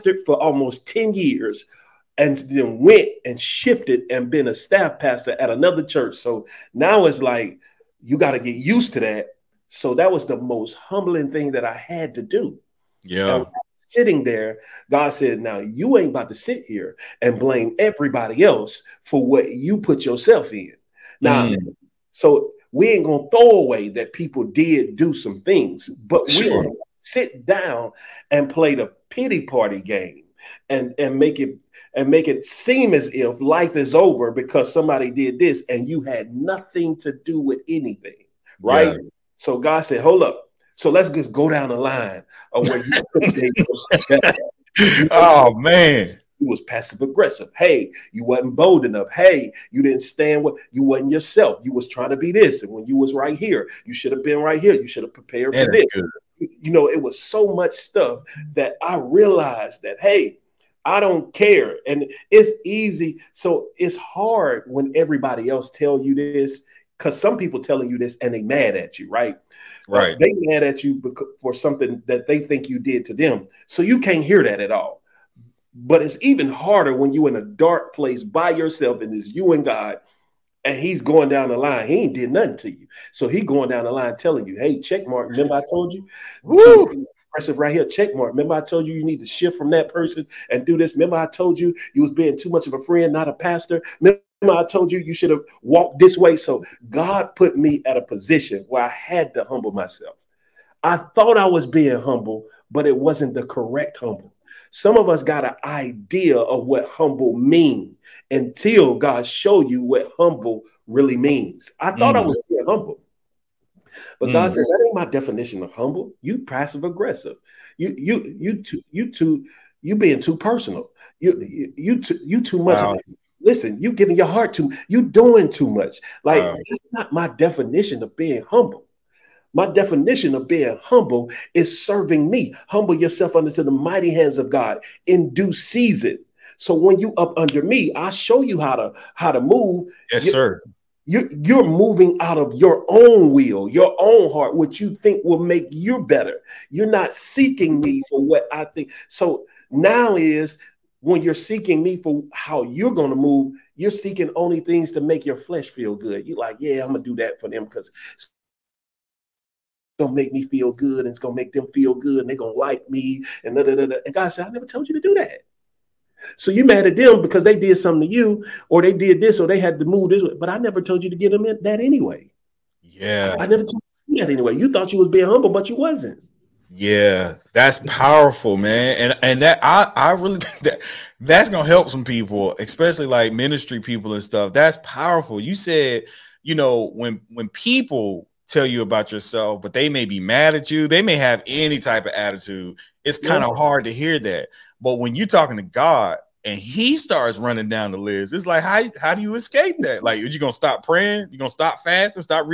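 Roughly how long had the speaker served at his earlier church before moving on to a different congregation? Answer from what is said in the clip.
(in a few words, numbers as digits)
almost 10 years.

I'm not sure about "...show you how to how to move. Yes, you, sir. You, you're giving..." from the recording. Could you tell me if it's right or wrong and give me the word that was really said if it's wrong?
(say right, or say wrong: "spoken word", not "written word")
wrong: "moving", not "giving".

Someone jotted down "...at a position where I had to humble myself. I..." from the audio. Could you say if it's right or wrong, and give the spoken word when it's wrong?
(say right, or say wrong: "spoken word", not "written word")
right.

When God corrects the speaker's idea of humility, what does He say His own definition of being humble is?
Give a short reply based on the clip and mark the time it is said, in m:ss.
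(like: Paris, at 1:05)
serving me, at 2:11.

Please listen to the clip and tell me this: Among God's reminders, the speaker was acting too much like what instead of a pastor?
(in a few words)
a friend.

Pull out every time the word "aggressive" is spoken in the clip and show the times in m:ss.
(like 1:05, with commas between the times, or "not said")
0:47, 1:56.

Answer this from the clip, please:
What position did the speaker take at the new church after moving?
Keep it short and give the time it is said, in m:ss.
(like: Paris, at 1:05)
staff pastor, at 0:04.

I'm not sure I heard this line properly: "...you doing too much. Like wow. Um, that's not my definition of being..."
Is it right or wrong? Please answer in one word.
right.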